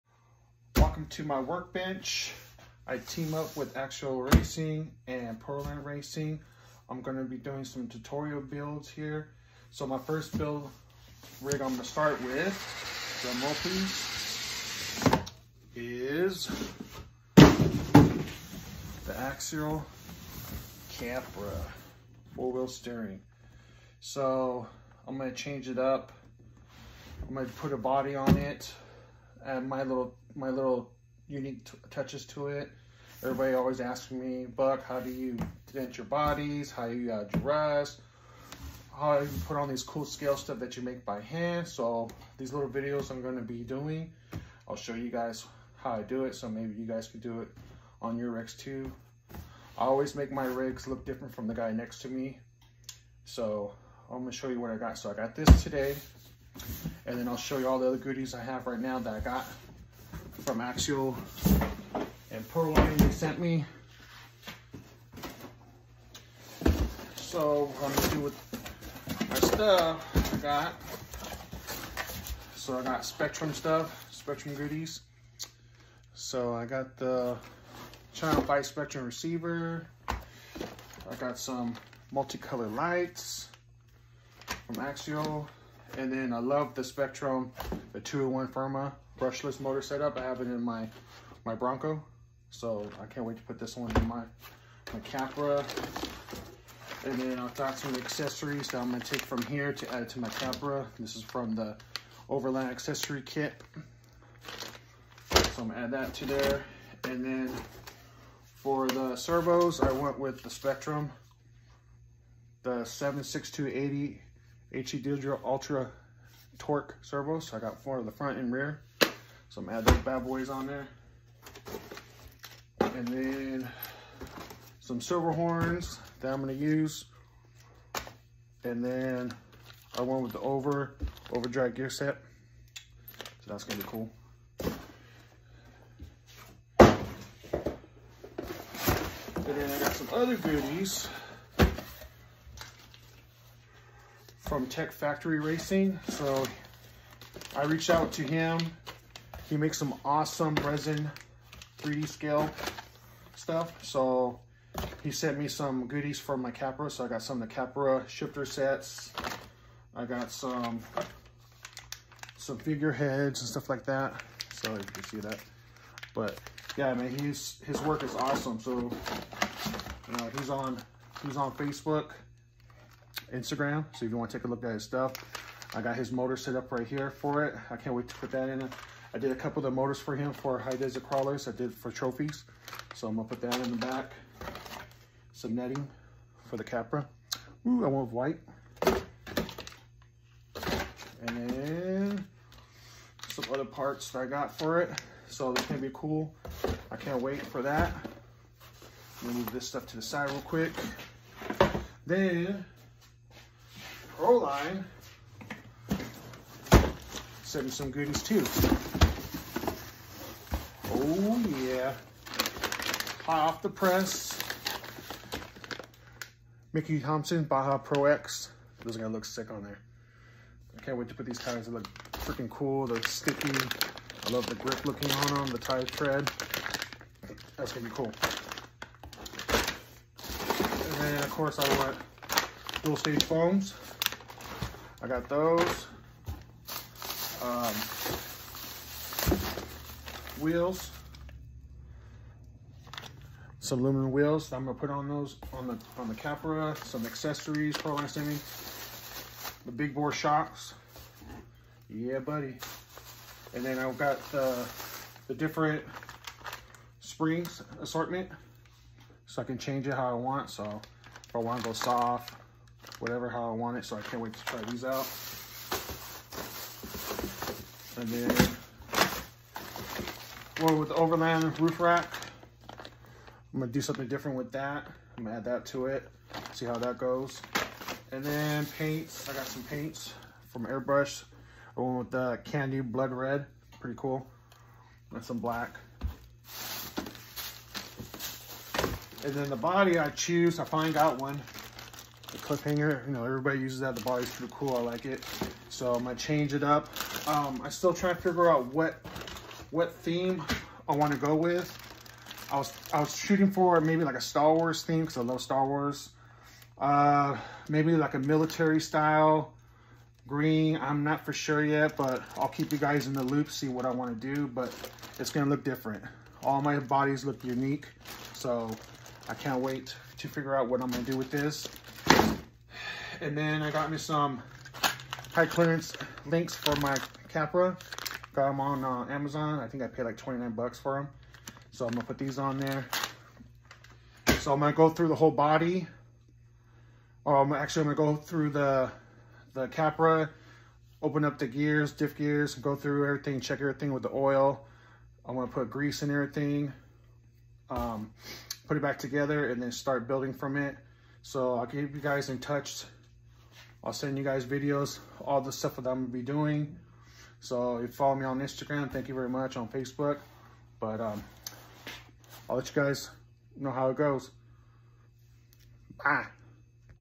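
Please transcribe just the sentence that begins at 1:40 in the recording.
This is from the Overland accessory kit.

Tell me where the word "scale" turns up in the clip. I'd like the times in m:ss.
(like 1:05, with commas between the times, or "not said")
0:40, 2:32.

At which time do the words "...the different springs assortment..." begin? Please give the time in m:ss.
4:15.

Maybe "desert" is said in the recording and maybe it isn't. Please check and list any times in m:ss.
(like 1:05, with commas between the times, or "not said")
3:00.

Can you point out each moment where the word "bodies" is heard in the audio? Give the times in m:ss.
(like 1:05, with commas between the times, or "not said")
0:36, 5:16.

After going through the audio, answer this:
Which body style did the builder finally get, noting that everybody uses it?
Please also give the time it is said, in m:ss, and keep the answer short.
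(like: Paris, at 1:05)
Cliffhanger, at 4:52.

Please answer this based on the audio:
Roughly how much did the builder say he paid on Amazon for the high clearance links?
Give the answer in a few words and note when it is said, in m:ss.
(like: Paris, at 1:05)
$29, at 5:30.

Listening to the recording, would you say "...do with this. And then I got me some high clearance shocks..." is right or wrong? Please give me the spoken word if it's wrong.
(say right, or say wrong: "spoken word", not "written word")
wrong: "links", not "shocks".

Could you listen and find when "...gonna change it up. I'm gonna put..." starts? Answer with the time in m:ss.
0:25.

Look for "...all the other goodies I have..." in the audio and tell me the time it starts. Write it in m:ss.
0:57.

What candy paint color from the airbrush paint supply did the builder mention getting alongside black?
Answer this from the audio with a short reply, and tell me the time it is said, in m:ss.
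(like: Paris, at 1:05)
Candy blood red, at 4:42.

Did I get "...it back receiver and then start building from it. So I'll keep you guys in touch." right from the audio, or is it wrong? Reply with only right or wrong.
wrong.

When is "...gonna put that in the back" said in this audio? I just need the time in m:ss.
3:03.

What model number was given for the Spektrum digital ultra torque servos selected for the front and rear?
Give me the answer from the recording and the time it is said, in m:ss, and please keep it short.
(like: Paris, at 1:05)
76280, at 1:52.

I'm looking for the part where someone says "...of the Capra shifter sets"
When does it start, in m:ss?
2:37.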